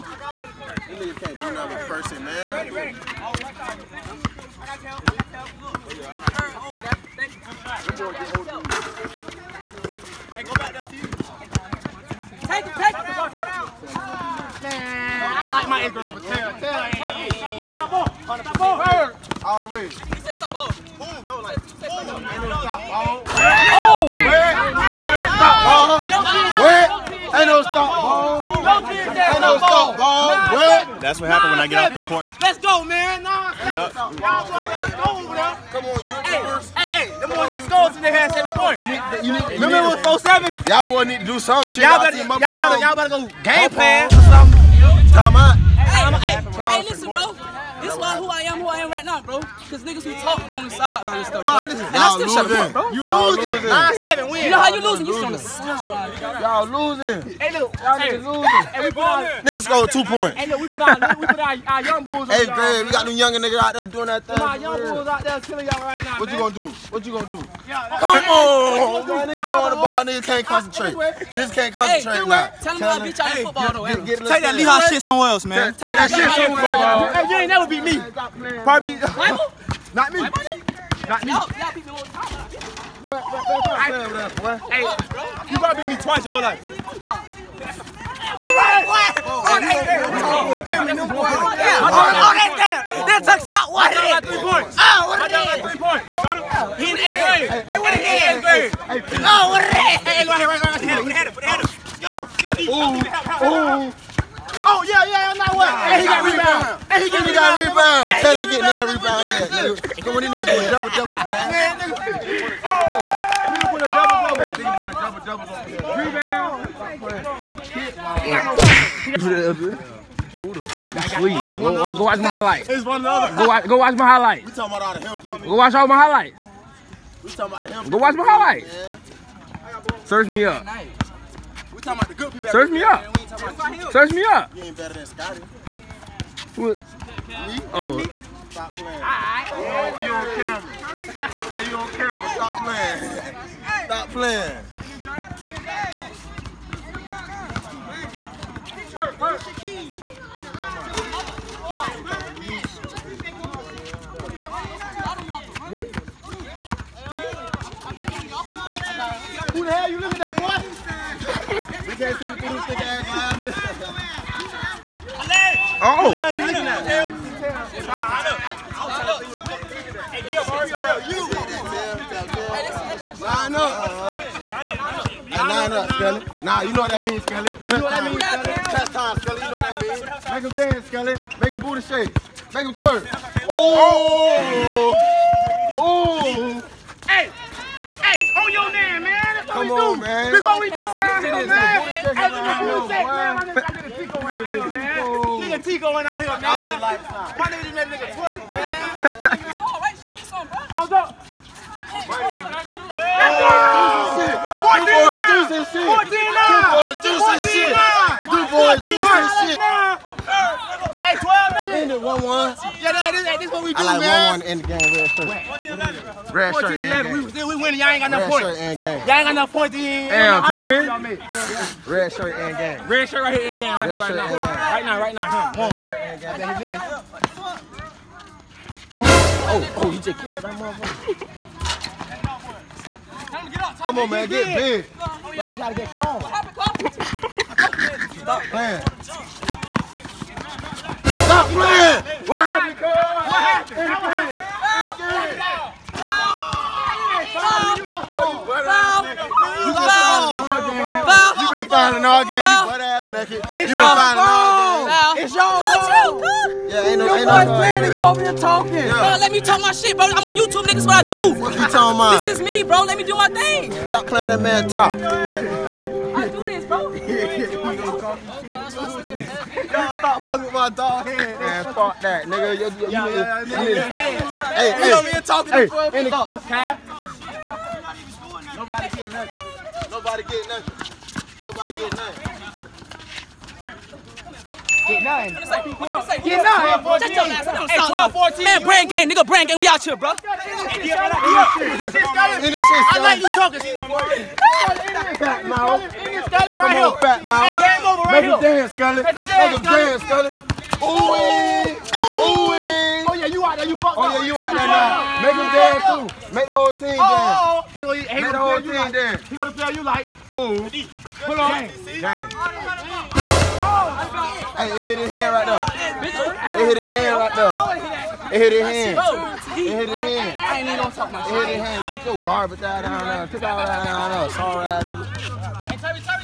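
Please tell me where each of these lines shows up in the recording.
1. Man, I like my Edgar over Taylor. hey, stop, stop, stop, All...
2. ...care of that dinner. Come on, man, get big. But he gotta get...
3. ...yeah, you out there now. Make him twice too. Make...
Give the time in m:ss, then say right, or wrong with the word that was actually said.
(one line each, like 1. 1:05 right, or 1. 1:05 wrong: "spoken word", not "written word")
1. 0:14 right
2. 3:50 wrong: "motherfucker", not "dinner"
3. 5:04 wrong: "dance", not "twice".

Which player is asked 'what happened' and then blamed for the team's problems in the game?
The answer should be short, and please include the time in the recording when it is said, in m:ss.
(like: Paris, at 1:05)
Cole, at 4:02.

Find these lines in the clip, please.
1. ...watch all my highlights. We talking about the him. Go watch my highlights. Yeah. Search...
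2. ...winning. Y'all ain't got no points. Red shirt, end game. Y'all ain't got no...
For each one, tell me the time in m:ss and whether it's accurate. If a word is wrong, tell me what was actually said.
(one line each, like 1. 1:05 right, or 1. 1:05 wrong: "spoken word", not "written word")
1. 2:05 right
2. 3:37 right.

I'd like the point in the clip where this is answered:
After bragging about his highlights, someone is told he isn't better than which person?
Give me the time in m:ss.
2:15.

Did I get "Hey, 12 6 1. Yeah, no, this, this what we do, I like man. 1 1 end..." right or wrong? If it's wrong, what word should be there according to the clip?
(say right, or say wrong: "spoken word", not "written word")
wrong: "1", not "6".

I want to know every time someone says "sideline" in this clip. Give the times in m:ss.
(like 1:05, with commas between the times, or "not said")
0:50, 0:55.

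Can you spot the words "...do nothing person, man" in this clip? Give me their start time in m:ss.
0:01.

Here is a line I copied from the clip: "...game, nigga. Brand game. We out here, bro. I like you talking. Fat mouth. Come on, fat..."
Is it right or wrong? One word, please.
right.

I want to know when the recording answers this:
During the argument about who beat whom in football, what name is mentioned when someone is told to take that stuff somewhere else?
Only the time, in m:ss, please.
1:14.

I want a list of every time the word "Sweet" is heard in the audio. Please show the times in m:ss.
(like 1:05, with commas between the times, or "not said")
2:01.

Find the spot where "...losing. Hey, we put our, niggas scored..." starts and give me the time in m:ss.
0:58.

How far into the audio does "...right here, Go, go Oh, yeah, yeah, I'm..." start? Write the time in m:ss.
1:40.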